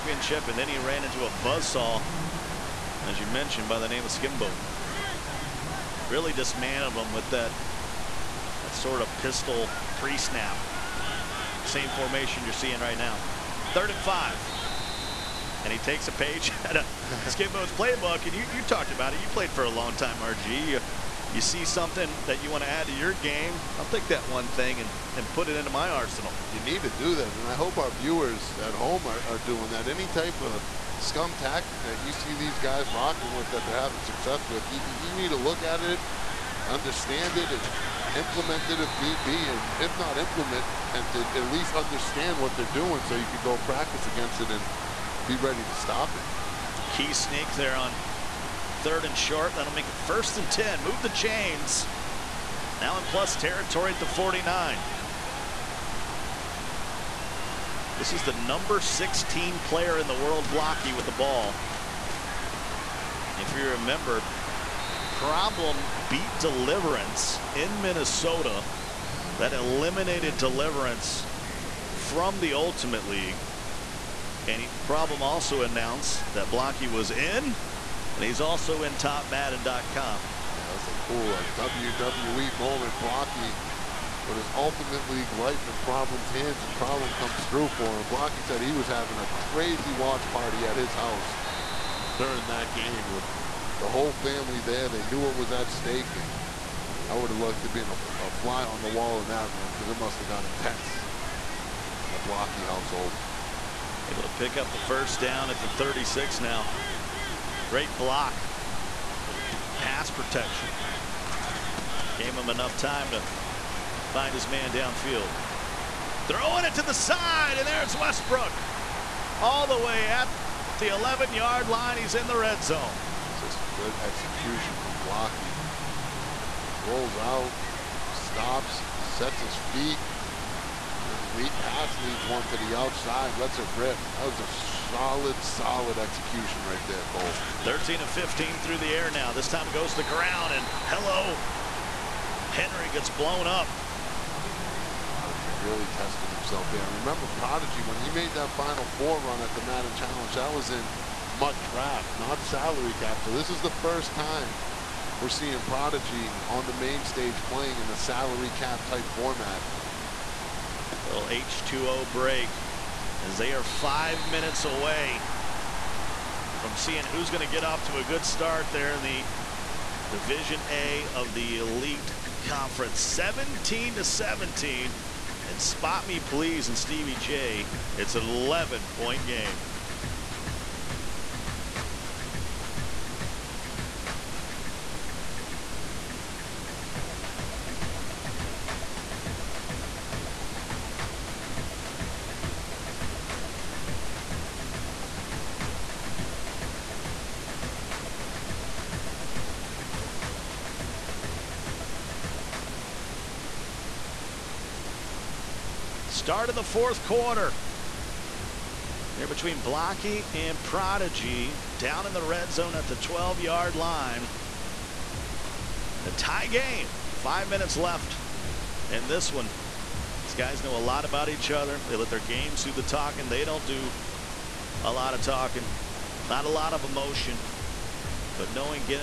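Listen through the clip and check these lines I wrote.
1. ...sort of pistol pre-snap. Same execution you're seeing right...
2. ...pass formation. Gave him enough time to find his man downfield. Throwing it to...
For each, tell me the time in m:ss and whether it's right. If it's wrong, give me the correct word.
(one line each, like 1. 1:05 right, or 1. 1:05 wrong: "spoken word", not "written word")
1. 0:08 wrong: "formation", not "execution"
2. 1:49 wrong: "protection", not "formation".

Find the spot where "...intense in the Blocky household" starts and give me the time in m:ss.
1:40.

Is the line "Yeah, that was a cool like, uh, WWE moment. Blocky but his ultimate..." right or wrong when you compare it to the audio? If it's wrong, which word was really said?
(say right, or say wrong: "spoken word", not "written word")
right.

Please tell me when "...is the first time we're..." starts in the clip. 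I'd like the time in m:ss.
2:33.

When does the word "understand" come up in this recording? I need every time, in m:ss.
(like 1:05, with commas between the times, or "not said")
0:36, 0:41.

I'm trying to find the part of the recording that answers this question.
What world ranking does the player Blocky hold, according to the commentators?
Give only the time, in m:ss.
0:58.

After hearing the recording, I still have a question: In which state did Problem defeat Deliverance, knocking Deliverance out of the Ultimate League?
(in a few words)
Minnesota.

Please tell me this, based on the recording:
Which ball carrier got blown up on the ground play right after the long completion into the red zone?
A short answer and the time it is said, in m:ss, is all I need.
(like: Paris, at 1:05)
Henry, at 2:22.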